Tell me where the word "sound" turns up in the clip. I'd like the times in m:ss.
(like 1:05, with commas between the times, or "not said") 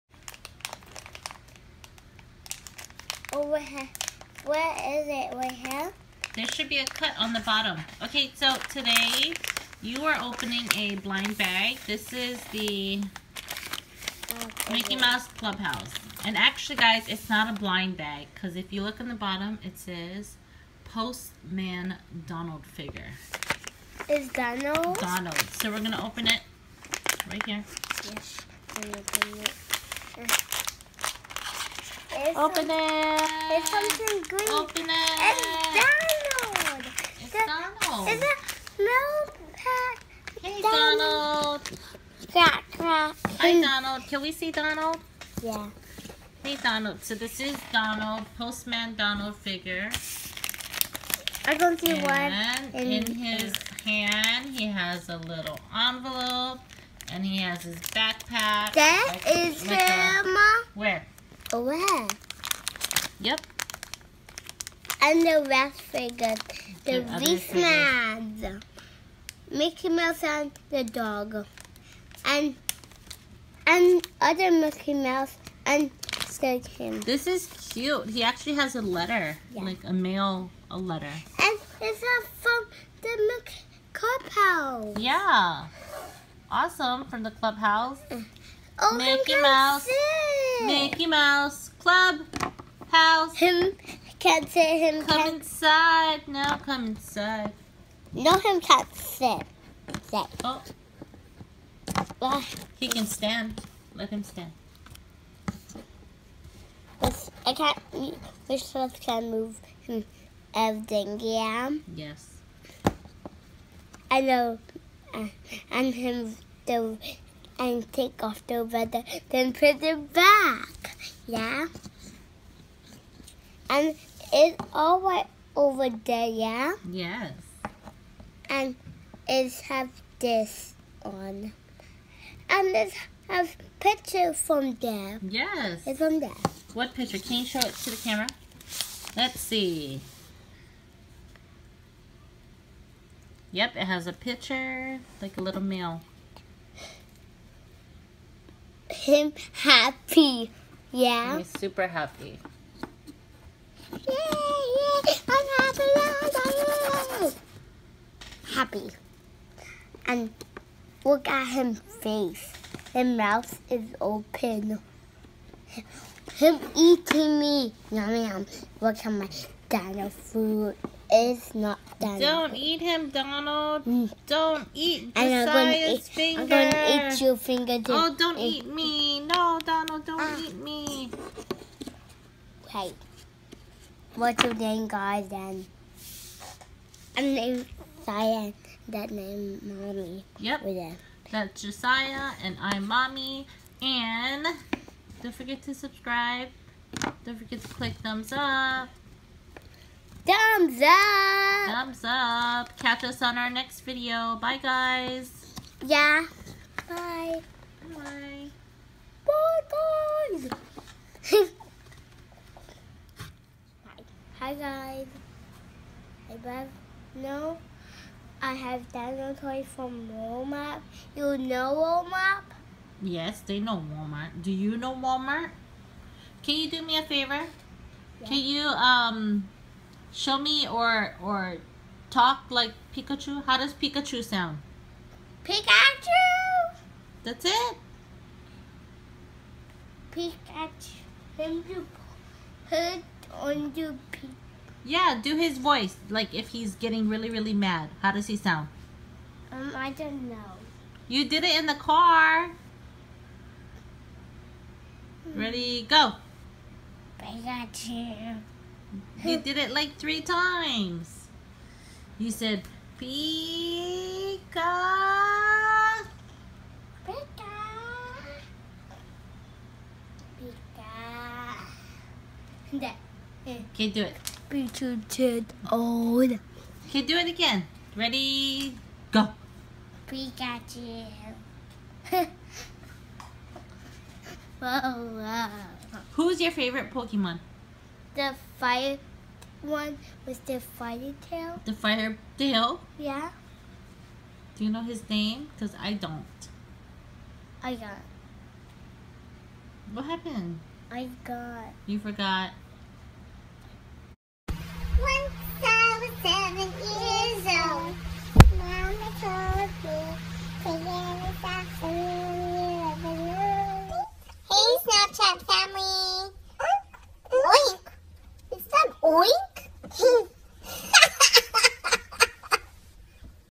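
3:54, 4:08.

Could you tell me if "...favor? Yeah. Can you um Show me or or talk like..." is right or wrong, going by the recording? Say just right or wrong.
right.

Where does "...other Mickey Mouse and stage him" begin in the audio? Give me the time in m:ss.
1:14.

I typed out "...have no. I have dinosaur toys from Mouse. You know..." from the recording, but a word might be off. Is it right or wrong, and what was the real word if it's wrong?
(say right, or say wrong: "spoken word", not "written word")
wrong: "Walmart", not "Mouse".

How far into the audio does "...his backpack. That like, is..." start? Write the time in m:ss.
0:57.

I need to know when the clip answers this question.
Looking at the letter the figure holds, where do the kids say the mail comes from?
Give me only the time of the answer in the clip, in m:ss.
1:22.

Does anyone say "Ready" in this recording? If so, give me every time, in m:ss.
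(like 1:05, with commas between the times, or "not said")
4:15, 4:37.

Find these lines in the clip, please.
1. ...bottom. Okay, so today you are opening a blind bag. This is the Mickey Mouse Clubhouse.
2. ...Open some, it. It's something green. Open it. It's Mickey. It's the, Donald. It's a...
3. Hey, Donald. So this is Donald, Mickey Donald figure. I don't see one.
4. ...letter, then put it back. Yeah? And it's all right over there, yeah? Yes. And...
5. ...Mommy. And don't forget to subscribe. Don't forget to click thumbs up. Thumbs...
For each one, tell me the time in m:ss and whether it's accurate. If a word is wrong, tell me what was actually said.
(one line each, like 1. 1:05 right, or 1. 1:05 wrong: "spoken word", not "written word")
1. 0:07 right
2. 0:32 wrong: "Donald", not "Mickey"
3. 0:46 wrong: "Postman", not "Mickey"
4. 1:58 wrong: "weather", not "letter"
5. 3:12 right.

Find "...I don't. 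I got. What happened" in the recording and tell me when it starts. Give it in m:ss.
4:55.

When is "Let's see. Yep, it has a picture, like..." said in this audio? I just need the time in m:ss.
2:19.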